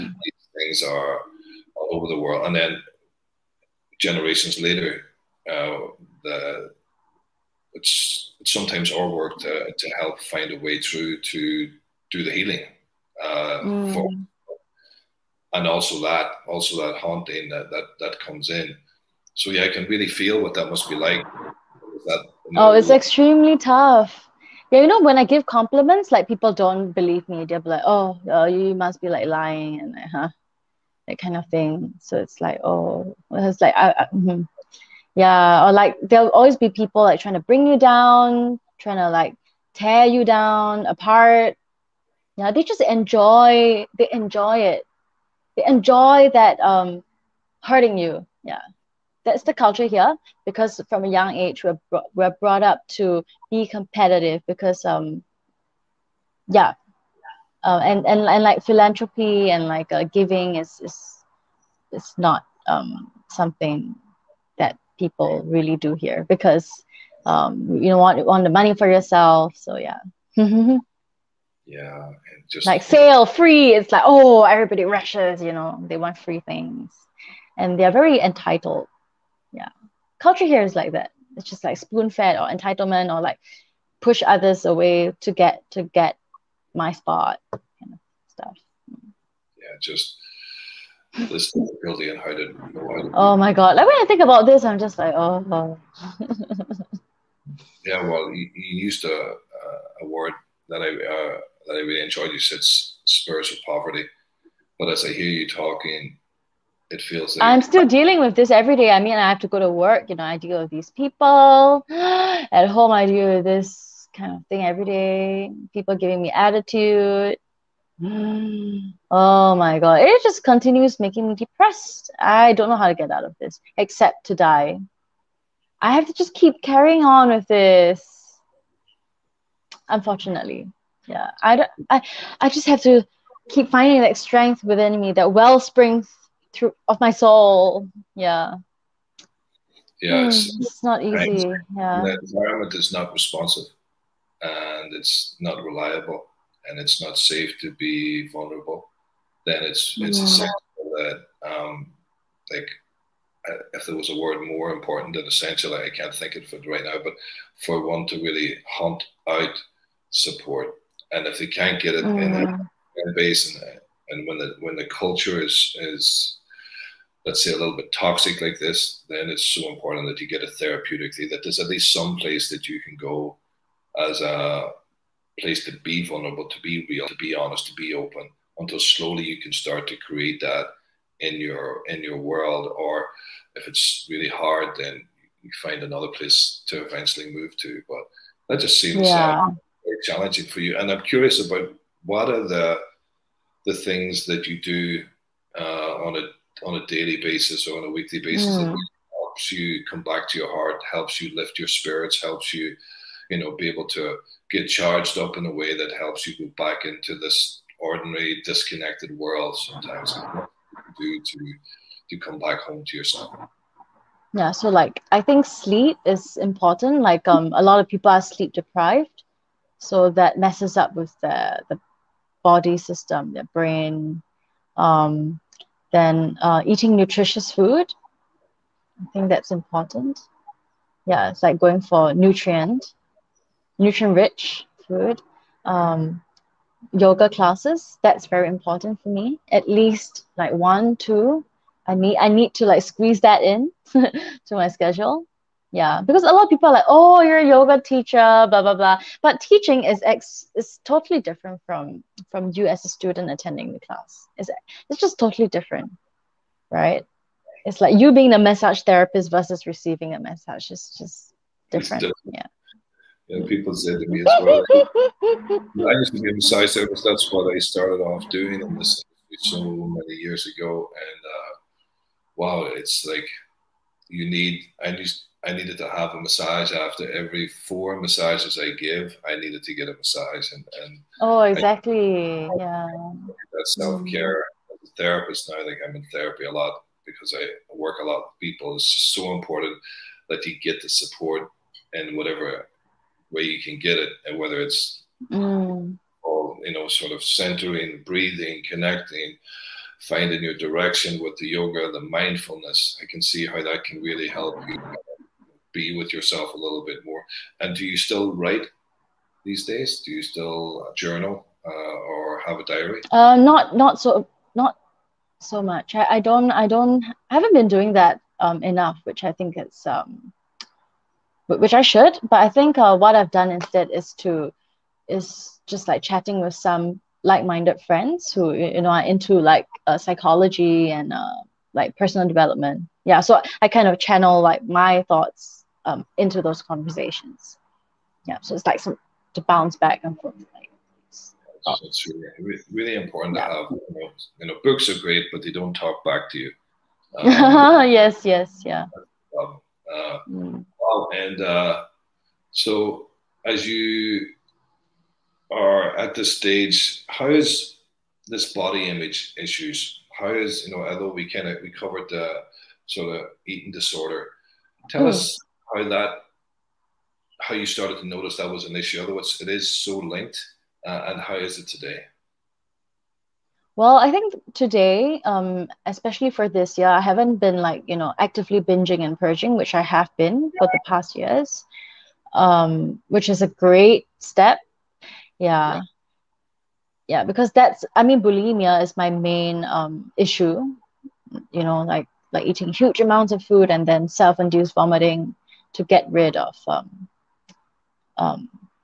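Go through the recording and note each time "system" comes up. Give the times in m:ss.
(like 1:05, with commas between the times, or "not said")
3:42.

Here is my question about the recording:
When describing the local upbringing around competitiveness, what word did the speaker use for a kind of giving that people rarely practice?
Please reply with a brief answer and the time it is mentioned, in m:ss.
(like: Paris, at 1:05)
philanthropy, at 0:58.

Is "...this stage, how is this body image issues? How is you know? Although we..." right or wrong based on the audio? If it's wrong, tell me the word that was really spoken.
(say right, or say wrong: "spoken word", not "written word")
right.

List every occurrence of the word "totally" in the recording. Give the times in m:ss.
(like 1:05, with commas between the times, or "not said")
4:10, 4:15.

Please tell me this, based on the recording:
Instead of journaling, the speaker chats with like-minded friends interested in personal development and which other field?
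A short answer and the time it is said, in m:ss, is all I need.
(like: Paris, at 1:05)
psychology, at 5:29.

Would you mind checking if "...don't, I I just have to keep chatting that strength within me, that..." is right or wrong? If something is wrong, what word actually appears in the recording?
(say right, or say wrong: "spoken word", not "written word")
wrong: "finding", not "chatting".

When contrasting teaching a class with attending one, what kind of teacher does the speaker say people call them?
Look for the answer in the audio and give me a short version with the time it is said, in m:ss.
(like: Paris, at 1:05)
yoga teacher, at 4:07.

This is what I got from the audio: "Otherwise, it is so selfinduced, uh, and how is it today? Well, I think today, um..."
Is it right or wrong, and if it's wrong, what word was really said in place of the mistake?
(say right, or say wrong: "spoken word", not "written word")
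wrong: "linked", not "selfinduced".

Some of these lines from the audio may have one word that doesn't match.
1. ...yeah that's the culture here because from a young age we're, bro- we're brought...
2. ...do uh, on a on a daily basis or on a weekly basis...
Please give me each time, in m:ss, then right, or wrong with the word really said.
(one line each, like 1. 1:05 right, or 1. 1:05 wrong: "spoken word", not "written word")
1. 0:48 right
2. 3:14 right.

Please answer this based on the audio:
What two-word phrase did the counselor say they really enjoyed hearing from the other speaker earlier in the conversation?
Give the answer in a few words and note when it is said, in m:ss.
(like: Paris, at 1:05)
spiritual poverty, at 1:42.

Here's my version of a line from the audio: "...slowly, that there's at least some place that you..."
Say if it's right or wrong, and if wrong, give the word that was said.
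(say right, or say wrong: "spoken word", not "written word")
wrong: "therapeutically", not "slowly".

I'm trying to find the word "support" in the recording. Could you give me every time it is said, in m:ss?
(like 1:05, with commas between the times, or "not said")
2:40, 4:50.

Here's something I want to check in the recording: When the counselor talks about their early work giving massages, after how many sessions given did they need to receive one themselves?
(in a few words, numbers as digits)
4.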